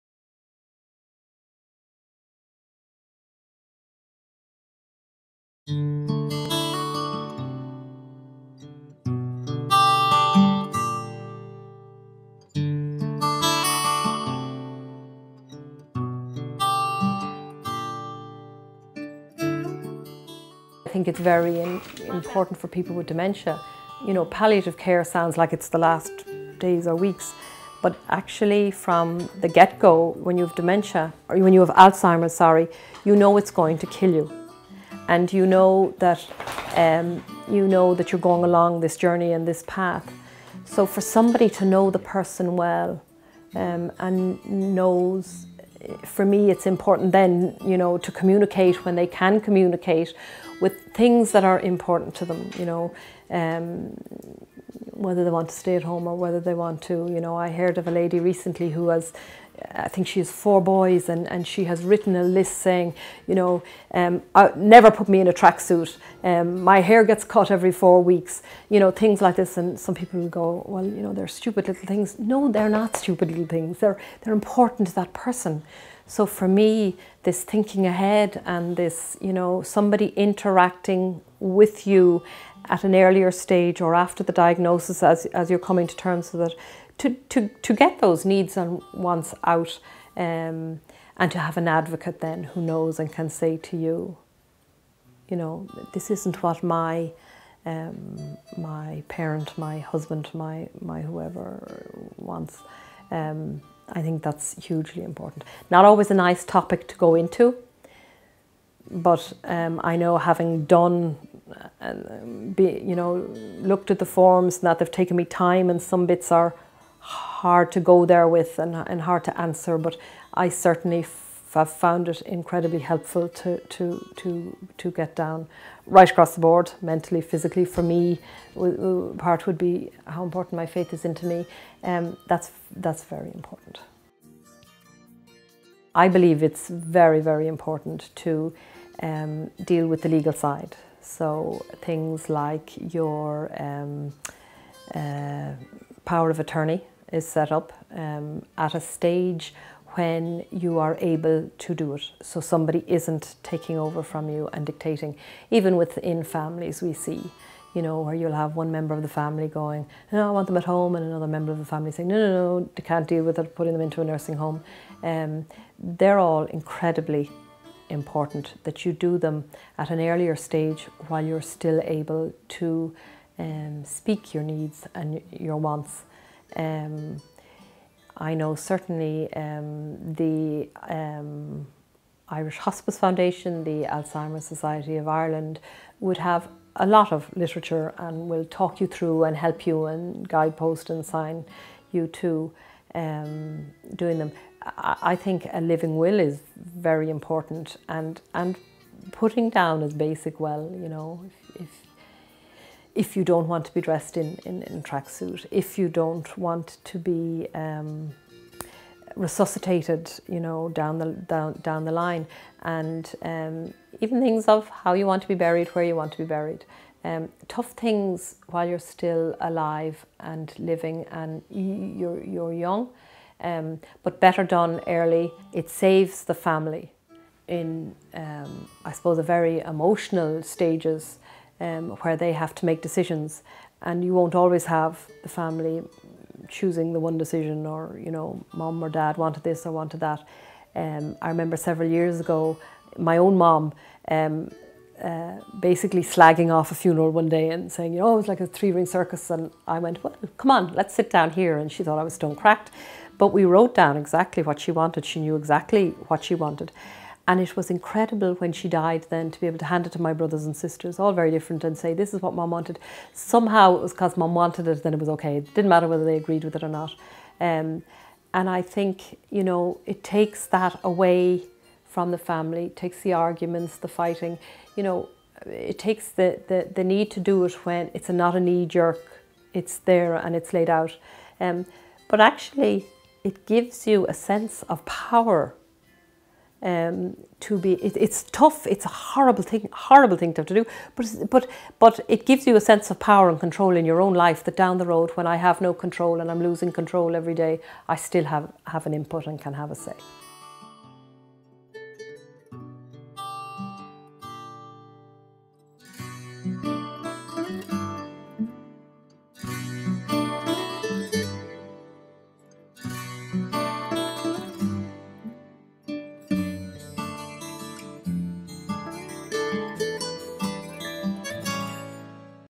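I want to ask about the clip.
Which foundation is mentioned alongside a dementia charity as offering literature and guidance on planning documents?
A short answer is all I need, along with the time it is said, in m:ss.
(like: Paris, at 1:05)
Irish Hospice Foundation, at 3:02.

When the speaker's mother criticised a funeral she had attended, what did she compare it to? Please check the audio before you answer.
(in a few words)
a three ring circus.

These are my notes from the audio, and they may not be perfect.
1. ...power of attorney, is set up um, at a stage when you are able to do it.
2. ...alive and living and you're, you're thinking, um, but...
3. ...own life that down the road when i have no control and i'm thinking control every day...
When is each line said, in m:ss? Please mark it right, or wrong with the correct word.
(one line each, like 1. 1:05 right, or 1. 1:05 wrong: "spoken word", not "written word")
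1. 2:26 right
2. 3:39 wrong: "young", not "thinking"
3. 4:54 wrong: "losing", not "thinking".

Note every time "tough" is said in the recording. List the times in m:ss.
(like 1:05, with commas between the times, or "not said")
3:37, 4:48.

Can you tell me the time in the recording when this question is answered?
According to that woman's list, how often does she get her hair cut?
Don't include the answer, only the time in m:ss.
1:07.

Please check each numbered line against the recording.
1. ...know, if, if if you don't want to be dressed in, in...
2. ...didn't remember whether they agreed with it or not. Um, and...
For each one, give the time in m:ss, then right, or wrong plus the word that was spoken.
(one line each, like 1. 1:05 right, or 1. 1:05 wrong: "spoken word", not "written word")
1. 3:20 right
2. 4:25 wrong: "matter", not "remember".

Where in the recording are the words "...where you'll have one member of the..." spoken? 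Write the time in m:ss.
2:38.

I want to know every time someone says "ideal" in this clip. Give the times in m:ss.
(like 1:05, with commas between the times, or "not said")
not said.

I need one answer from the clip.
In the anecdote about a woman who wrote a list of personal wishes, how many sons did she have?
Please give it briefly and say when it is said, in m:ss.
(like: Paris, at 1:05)
4, at 1:00.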